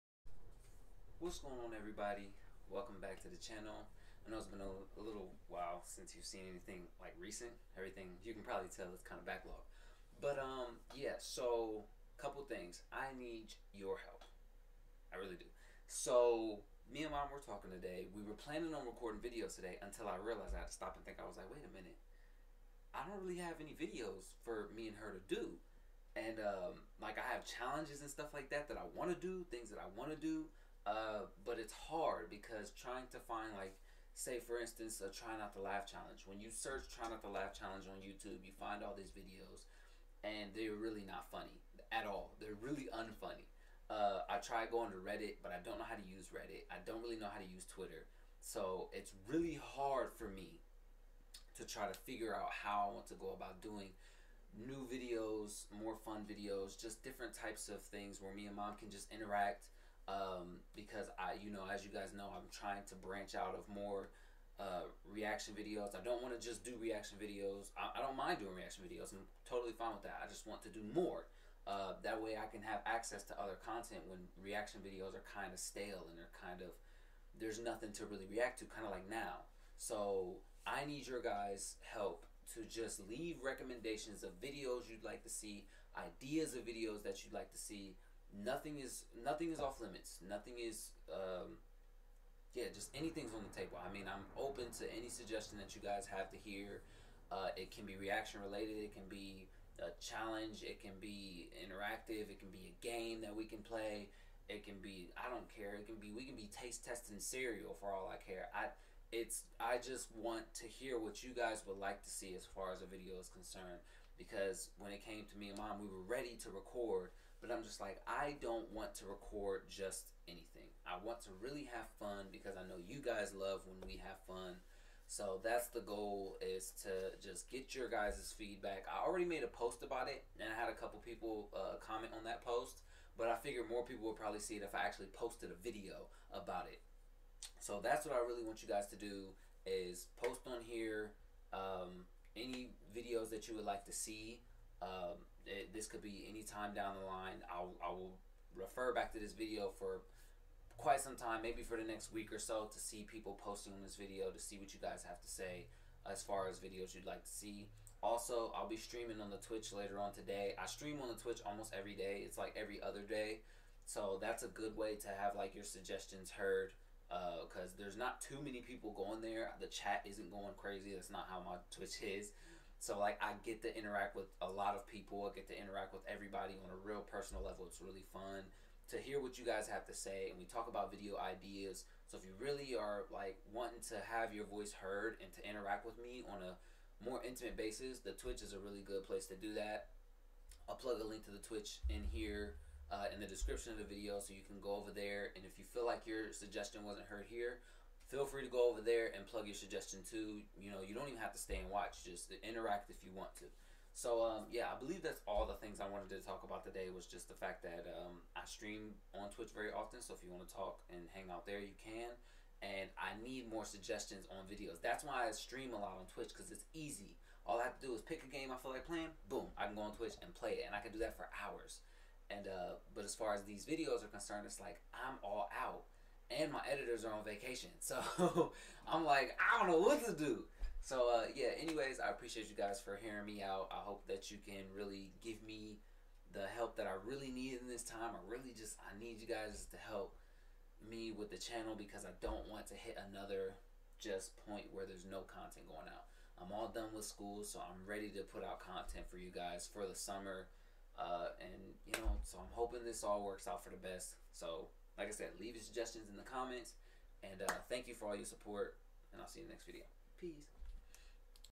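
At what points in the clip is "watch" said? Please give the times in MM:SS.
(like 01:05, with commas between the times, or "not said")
03:21.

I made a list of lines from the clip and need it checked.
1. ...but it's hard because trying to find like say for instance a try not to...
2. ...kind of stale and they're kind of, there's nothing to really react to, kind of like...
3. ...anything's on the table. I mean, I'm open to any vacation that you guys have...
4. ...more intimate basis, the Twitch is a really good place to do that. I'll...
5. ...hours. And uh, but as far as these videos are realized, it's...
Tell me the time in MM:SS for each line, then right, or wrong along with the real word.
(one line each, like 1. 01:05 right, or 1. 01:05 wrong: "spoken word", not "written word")
1. 00:31 right
2. 01:15 right
3. 01:32 wrong: "suggestion", not "vacation"
4. 03:07 right
5. 03:41 wrong: "concerned", not "realized".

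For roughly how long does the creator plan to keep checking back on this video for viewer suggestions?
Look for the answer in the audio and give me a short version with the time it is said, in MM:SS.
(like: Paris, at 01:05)
the next week, at 02:31.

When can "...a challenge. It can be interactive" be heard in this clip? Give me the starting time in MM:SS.
01:39.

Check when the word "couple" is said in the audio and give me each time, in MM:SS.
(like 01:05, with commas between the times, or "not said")
00:12, 02:10.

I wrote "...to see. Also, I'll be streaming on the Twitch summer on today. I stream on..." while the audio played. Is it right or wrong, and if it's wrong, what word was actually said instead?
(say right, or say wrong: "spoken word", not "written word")
wrong: "later", not "summer".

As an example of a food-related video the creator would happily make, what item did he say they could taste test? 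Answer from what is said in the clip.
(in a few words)
cereal.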